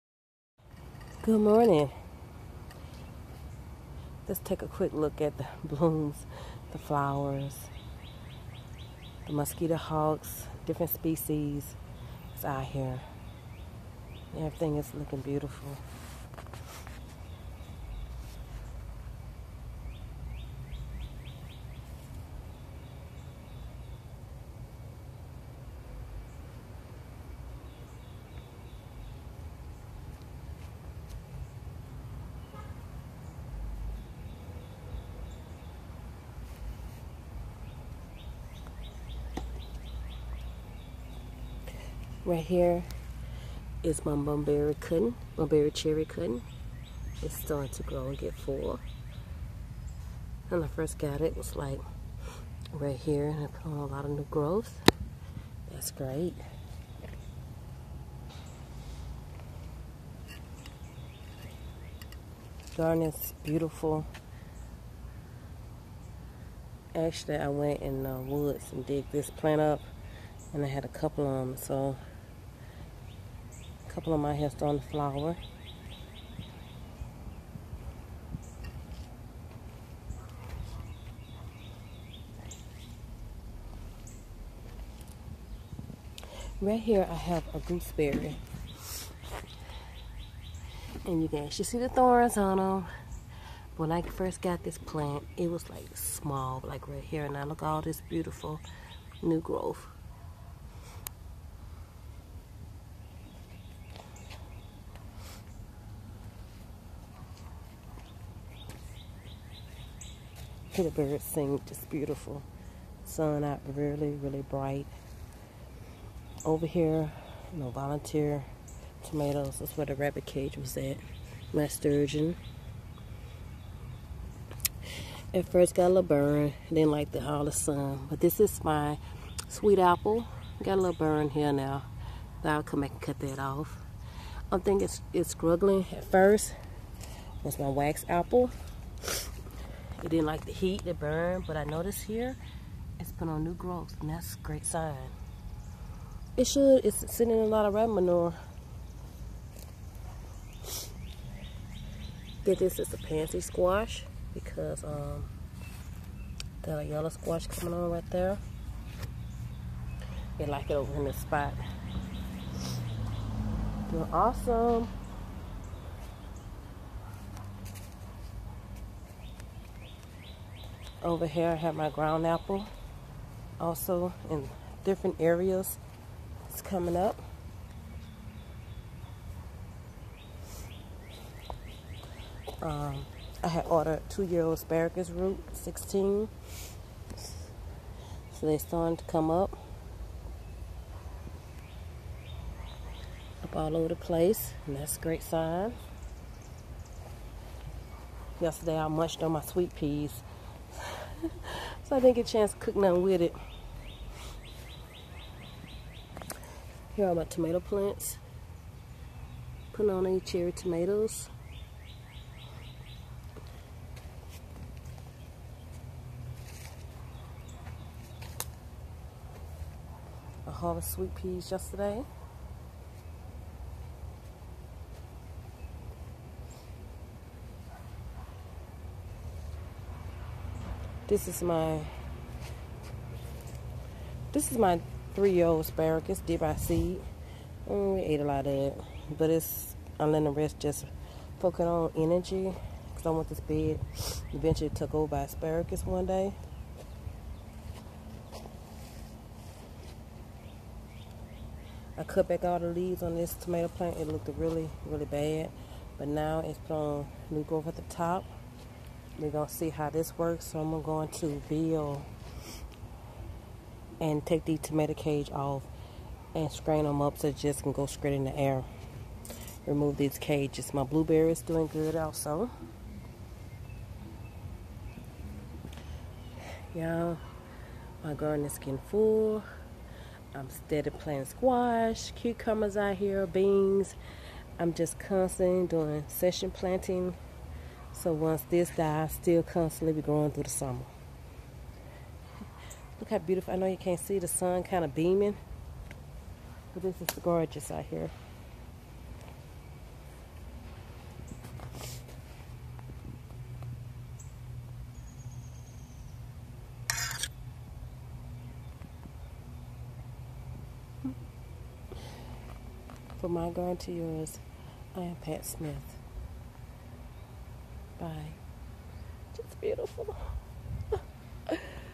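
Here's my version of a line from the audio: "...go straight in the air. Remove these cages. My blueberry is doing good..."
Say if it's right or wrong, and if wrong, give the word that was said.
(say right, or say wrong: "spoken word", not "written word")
right.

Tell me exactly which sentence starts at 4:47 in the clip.
So once this dies, still constantly be growing through the summer.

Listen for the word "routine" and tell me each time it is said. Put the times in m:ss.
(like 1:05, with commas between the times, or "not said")
not said.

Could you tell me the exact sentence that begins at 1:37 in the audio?
And now look all this beautiful new growth.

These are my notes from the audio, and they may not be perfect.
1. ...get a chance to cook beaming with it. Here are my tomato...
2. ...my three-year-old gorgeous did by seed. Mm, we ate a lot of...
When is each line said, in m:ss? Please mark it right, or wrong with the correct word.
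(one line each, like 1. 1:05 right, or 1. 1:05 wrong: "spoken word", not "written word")
1. 3:22 wrong: "nothing", not "beaming"
2. 3:54 wrong: "asparagus", not "gorgeous".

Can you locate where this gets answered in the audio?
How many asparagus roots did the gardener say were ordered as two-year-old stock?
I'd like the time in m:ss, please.
3:05.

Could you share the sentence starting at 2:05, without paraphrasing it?
At first got a little burn, didn't like the all the sun.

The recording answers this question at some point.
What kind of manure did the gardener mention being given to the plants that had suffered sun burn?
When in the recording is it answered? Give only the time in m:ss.
2:27.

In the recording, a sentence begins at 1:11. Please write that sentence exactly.
So a couple of my hair starting to flower.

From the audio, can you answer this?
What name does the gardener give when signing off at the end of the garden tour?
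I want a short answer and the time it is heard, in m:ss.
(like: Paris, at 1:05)
Pat Smith, at 5:15.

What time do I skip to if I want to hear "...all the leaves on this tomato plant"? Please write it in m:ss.
4:12.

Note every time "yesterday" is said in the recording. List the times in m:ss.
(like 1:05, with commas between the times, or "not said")
3:18, 3:41.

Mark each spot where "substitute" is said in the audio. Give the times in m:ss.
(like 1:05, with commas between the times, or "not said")
not said.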